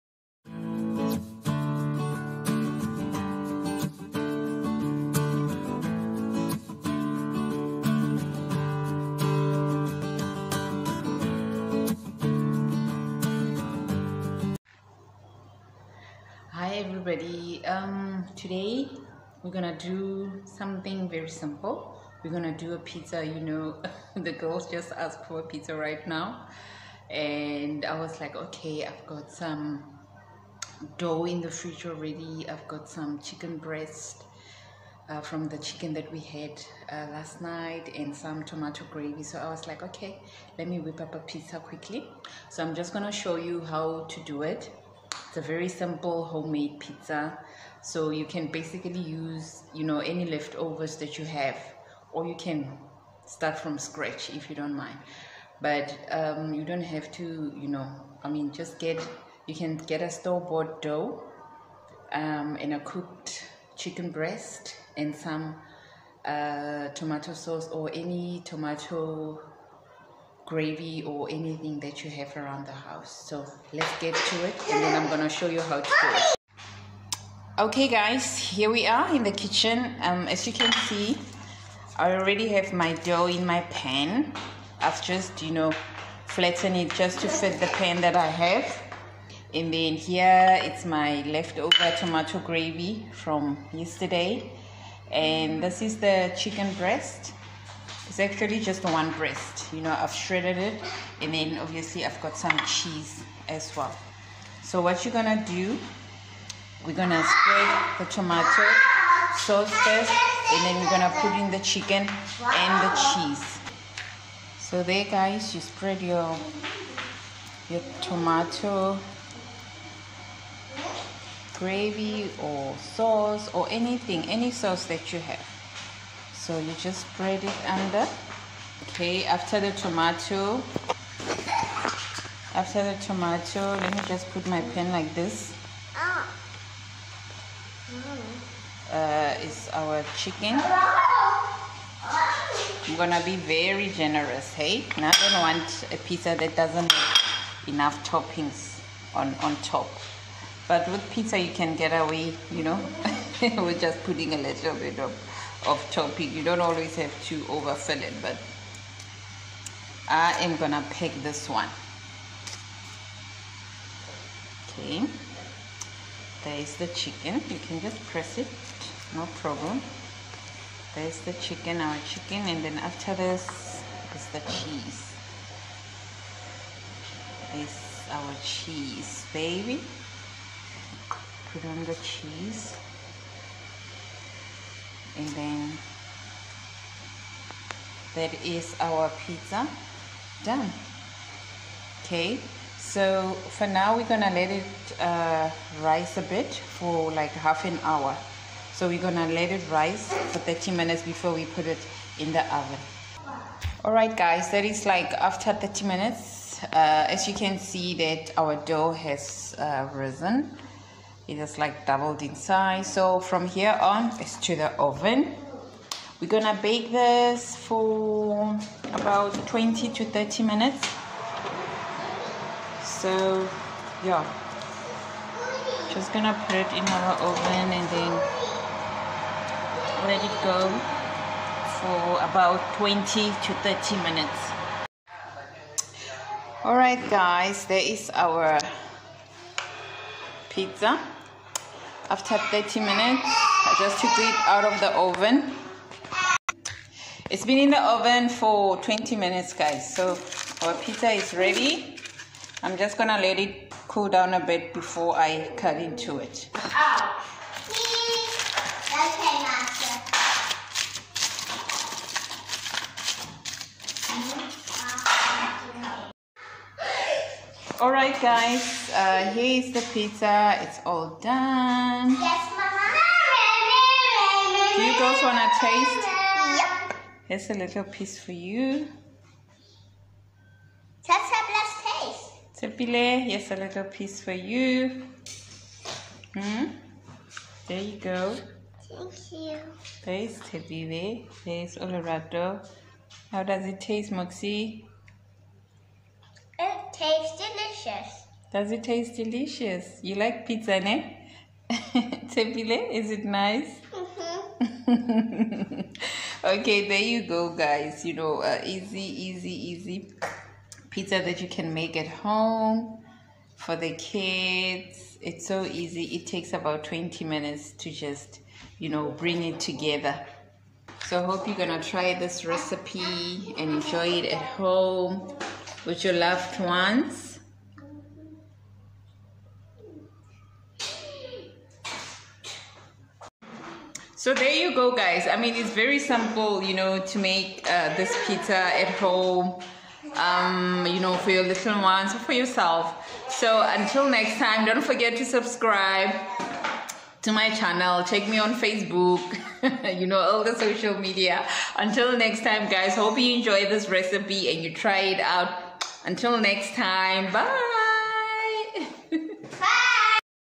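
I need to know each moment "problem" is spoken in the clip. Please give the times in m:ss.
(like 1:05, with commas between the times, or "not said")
2:49.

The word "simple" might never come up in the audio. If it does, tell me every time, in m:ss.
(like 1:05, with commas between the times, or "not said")
0:21, 0:45, 5:35.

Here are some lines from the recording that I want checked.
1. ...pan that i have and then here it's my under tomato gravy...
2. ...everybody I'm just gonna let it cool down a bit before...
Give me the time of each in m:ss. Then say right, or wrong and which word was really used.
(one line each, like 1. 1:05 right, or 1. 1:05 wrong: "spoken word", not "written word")
1. 1:27 wrong: "leftover", not "under"
2. 4:11 wrong: "ready", not "everybody".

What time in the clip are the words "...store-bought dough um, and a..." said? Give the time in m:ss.
1:00.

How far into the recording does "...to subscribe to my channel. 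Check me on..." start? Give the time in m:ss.
5:45.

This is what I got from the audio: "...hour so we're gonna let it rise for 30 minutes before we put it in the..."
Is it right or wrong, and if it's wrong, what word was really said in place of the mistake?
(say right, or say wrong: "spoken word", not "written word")
right.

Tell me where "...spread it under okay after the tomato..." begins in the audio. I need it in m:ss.
2:07.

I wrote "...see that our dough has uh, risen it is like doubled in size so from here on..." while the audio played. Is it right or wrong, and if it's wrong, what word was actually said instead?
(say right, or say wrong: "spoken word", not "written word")
right.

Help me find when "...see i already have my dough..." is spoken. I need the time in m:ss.
1:20.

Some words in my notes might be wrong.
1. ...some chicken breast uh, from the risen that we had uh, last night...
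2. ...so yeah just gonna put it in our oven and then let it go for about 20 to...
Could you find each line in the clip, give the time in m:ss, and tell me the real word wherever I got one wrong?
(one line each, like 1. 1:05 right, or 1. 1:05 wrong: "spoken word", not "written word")
1. 0:32 wrong: "chicken", not "risen"
2. 3:42 right.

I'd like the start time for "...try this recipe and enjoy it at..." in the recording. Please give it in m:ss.
5:21.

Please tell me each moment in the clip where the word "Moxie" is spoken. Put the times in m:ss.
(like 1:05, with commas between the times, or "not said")
4:54.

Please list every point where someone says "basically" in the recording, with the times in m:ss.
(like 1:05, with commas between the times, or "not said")
0:48.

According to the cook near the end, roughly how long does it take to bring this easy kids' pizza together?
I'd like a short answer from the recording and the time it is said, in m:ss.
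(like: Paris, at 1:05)
About 20 minutes, at 5:16.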